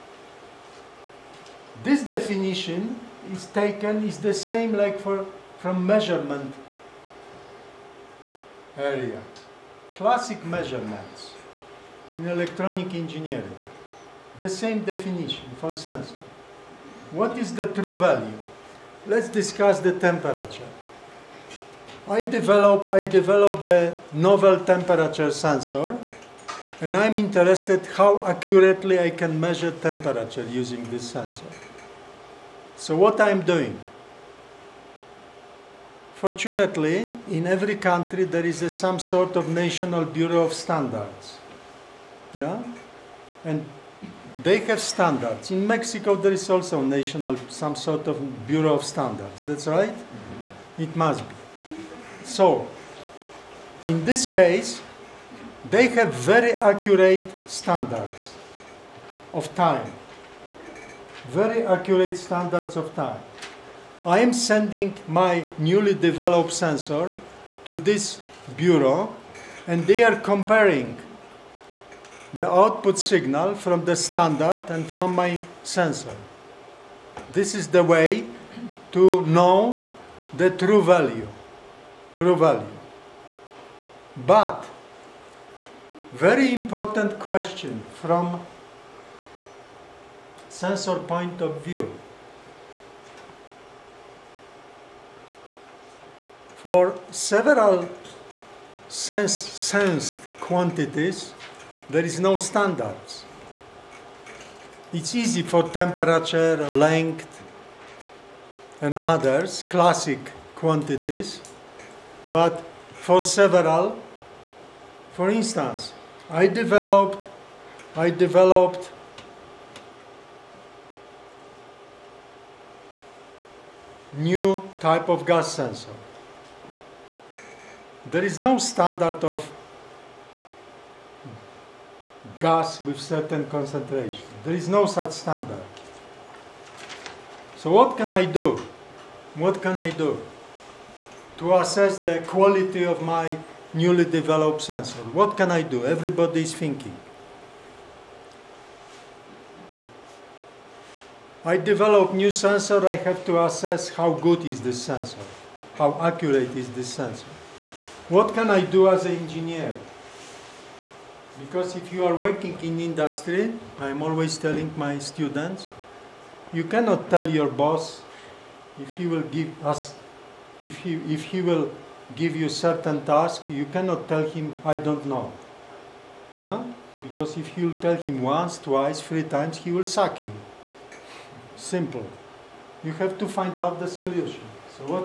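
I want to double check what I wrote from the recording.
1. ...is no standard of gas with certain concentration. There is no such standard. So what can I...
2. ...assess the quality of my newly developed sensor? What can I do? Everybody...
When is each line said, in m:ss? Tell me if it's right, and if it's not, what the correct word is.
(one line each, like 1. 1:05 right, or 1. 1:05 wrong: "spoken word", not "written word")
1. 2:08 right
2. 2:21 right.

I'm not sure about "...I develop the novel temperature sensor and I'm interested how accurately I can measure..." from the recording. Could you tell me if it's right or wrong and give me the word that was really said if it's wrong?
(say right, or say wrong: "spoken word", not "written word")
right.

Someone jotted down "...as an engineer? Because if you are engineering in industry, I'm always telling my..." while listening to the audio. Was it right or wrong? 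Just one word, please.
wrong.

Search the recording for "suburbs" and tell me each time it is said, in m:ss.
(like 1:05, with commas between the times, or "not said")
not said.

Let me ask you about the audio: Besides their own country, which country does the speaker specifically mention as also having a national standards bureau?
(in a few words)
Mexico.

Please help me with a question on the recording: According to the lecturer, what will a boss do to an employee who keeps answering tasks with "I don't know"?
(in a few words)
Sack you.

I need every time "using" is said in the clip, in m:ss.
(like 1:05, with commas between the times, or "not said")
0:30.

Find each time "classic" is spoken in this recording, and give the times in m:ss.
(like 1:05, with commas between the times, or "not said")
0:09, 1:49.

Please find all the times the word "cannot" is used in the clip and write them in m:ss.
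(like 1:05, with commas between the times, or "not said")
2:46, 2:53.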